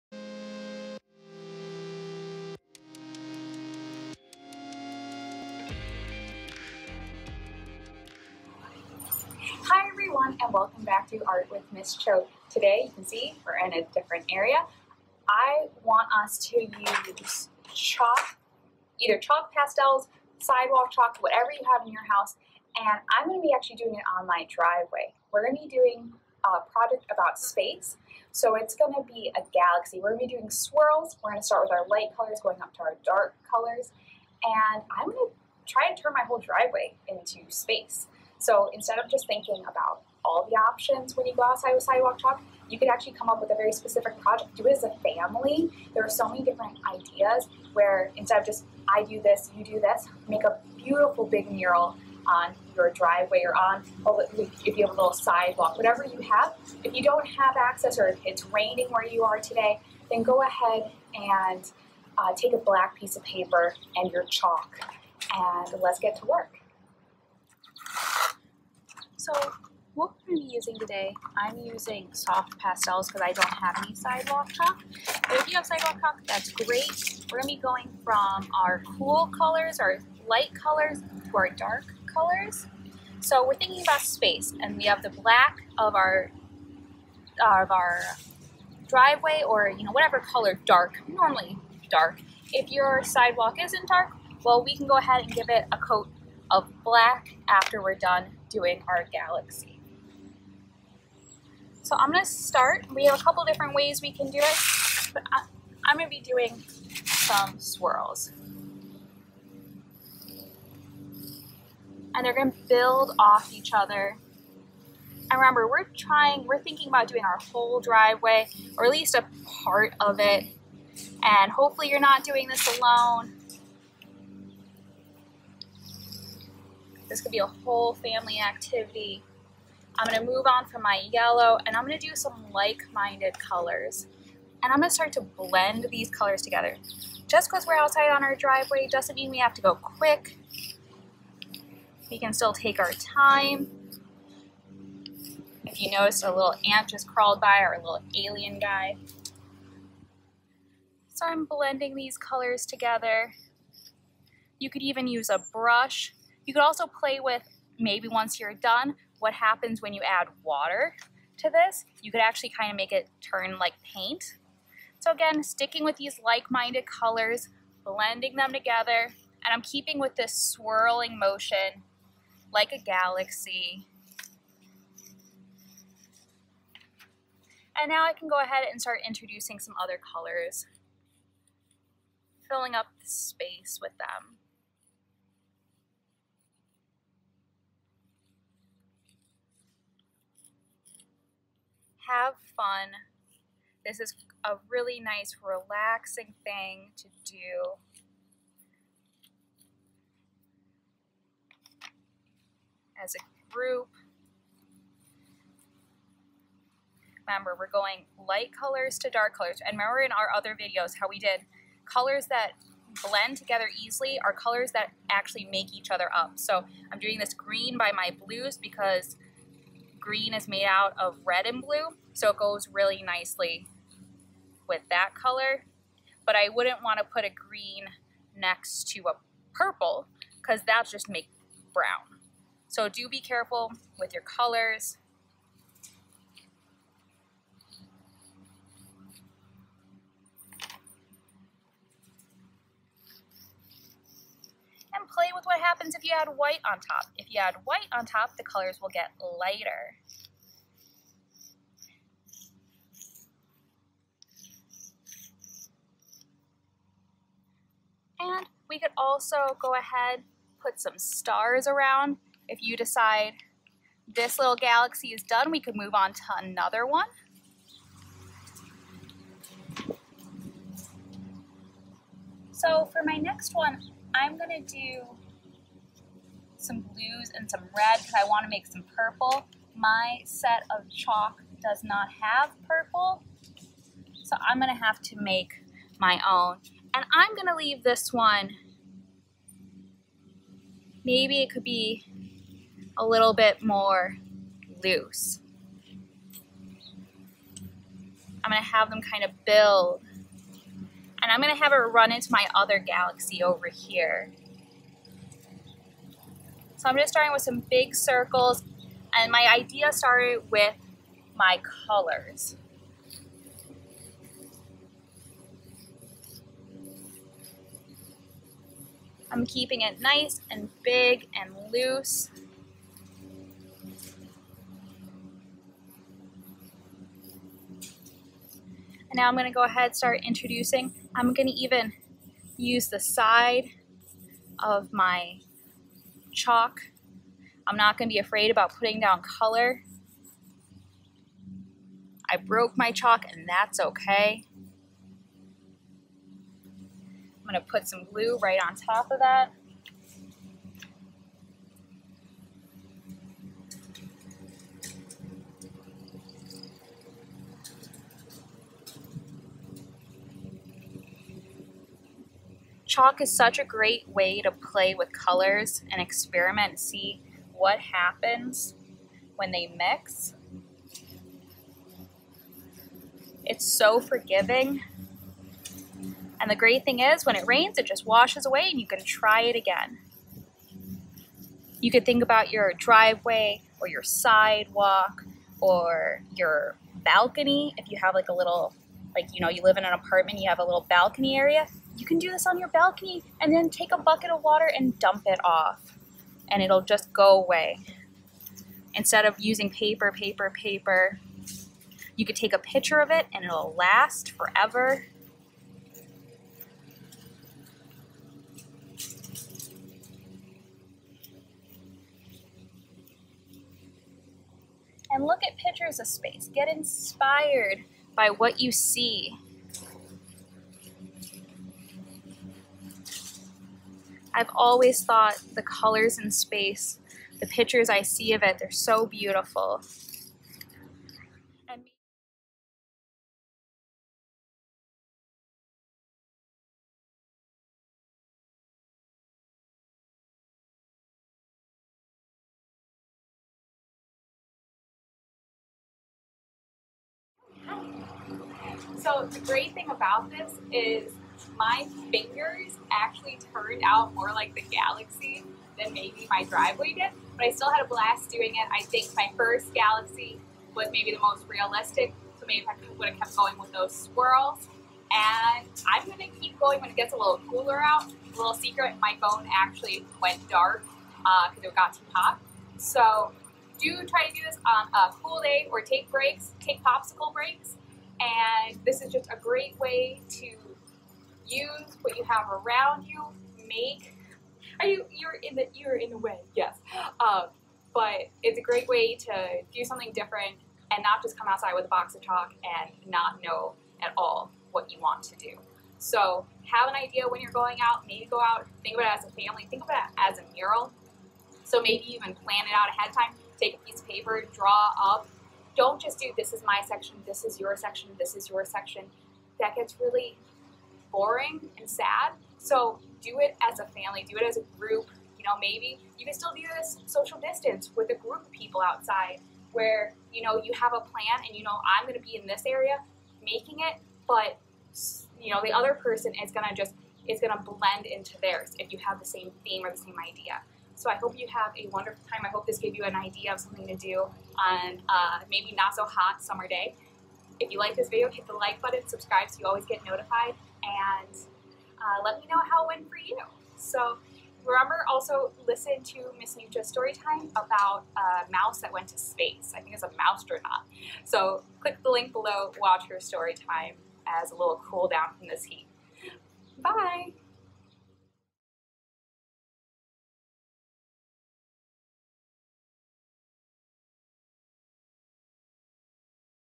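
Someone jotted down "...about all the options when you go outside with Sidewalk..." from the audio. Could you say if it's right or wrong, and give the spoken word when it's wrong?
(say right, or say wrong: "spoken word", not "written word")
right.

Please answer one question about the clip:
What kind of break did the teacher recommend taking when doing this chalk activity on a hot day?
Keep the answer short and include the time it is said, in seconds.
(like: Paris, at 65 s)
popsicle breaks, at 476 s.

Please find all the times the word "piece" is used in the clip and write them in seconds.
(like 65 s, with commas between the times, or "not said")
62 s, 503 s.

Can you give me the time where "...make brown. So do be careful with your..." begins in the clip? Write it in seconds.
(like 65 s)
231 s.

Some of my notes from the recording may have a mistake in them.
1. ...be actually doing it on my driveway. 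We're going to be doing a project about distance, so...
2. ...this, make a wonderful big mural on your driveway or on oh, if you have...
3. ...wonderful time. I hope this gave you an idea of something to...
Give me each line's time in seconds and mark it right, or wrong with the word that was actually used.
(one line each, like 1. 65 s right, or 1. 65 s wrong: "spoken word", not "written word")
1. 23 s wrong: "space", not "distance"
2. 49 s wrong: "beautiful", not "wonderful"
3. 531 s right.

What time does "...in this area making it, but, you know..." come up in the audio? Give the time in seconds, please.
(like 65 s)
522 s.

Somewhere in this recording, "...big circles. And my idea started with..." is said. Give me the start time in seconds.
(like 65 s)
307 s.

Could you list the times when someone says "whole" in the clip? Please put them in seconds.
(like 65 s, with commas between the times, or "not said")
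36 s, 117 s, 127 s.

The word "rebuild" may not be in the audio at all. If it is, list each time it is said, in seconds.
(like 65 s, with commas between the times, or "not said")
not said.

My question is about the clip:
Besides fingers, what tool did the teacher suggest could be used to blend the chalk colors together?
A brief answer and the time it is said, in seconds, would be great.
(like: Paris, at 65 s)
a brush, at 155 s.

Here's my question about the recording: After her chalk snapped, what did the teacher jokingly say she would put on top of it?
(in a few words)
glue.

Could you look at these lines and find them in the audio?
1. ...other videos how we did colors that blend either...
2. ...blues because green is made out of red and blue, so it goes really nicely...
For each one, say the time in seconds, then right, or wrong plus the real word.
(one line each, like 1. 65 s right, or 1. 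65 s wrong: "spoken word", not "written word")
1. 210 s wrong: "together", not "either"
2. 218 s right.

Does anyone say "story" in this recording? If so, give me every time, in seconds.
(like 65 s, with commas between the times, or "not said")
546 s, 553 s.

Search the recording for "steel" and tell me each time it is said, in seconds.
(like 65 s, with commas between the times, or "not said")
not said.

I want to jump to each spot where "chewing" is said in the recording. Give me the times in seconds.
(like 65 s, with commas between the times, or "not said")
not said.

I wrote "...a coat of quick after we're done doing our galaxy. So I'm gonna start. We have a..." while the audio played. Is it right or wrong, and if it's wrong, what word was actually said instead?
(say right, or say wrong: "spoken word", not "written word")
wrong: "black", not "quick".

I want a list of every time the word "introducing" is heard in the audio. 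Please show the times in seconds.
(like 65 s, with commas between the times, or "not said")
179 s, 330 s.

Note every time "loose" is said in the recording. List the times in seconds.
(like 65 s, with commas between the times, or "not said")
294 s, 321 s.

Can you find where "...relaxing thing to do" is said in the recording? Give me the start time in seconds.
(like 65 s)
195 s.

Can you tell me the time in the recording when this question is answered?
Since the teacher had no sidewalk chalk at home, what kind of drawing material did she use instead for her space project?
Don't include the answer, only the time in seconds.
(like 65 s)
72 s.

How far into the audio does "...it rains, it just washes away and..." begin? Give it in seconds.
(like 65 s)
377 s.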